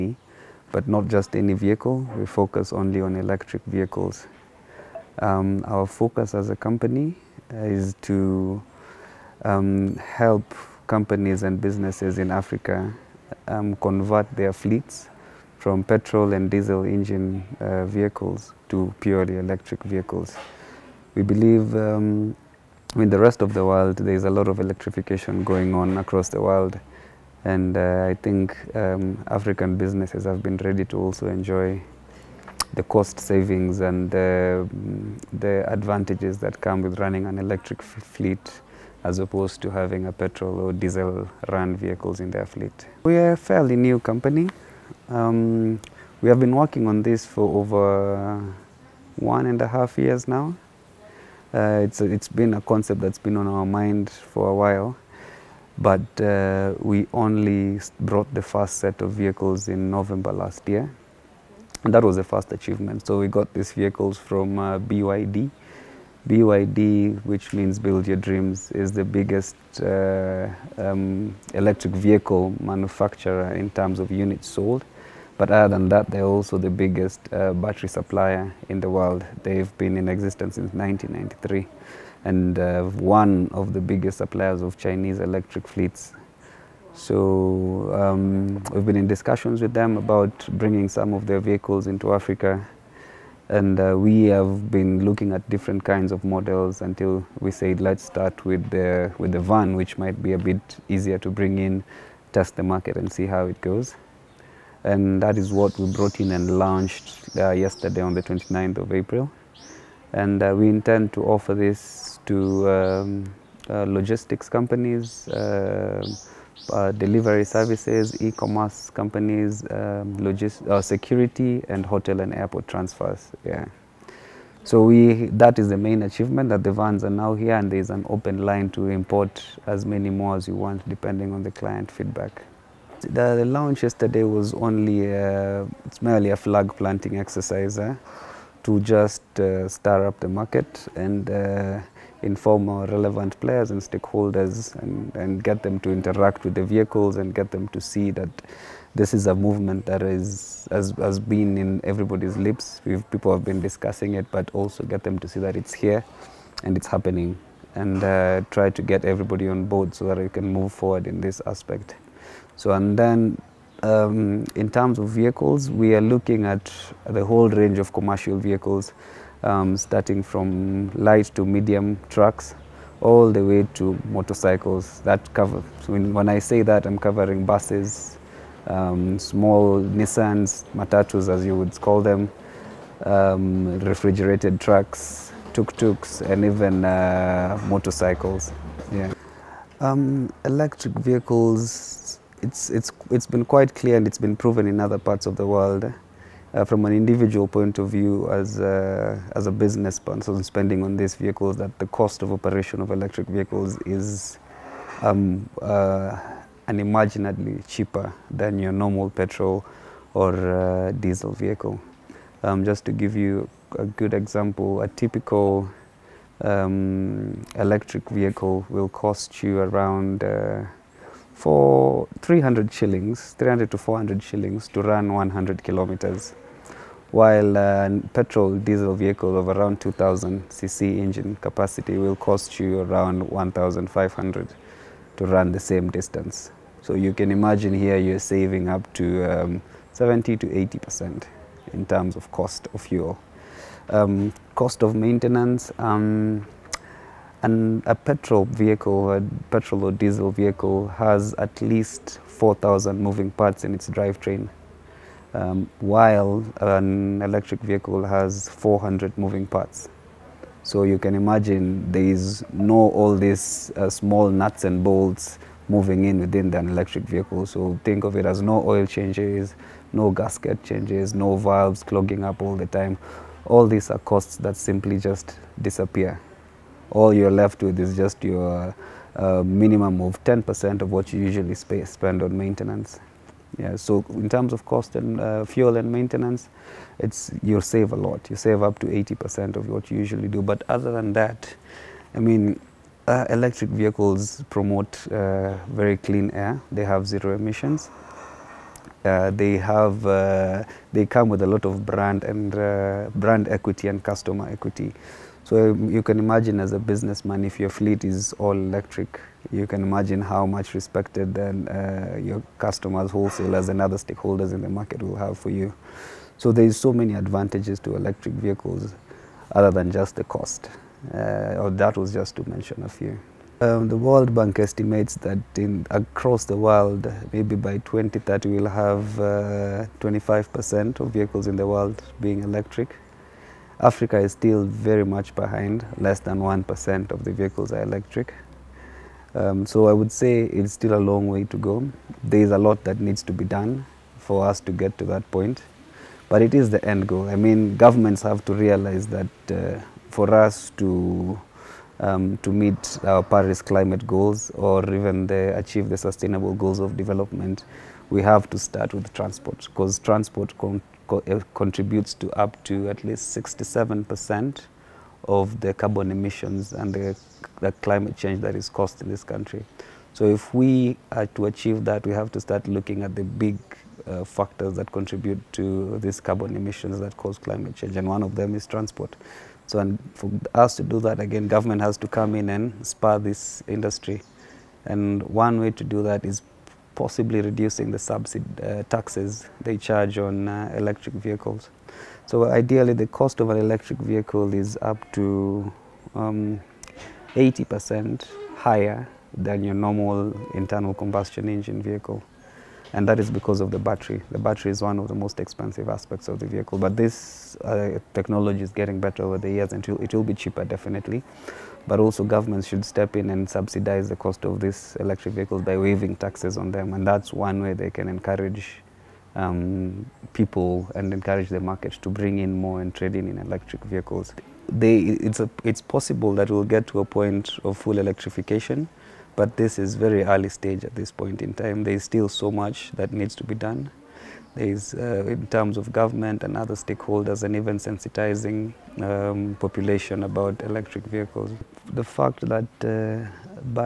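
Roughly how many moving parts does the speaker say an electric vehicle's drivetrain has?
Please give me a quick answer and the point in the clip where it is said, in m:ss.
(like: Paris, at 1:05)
400, at 4:18.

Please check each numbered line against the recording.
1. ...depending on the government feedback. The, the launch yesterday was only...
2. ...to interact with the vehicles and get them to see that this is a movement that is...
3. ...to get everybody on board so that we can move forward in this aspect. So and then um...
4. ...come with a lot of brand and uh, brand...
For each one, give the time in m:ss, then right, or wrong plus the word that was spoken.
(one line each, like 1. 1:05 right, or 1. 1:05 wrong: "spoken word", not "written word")
1. 2:10 wrong: "client", not "government"
2. 2:25 right
3. 2:38 right
4. 5:01 right.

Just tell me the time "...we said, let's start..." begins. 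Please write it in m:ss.
1:37.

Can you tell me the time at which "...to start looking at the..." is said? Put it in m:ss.
6:12.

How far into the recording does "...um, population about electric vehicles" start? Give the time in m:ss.
7:19.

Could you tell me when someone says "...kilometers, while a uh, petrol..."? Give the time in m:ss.
3:45.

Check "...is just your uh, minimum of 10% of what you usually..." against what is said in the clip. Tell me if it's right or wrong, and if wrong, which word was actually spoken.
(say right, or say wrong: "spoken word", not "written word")
right.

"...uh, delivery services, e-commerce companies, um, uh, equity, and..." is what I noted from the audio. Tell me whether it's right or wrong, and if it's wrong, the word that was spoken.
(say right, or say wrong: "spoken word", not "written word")
wrong: "security", not "equity".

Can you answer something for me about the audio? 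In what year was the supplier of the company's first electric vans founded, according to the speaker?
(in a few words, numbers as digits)
1993.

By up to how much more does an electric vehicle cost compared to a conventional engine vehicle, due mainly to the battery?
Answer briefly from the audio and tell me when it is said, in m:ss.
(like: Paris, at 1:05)
80%, at 6:36.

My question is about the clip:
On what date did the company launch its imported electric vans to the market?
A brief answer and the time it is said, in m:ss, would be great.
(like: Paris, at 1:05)
29th of April, at 1:48.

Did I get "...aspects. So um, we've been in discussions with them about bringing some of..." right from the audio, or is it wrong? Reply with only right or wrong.
wrong.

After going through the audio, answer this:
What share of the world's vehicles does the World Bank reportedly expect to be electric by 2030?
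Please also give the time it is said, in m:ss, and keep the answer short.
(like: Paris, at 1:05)
25%, at 5:29.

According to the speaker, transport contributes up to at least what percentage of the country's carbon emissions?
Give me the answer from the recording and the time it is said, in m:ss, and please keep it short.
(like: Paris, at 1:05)
67%, at 6:03.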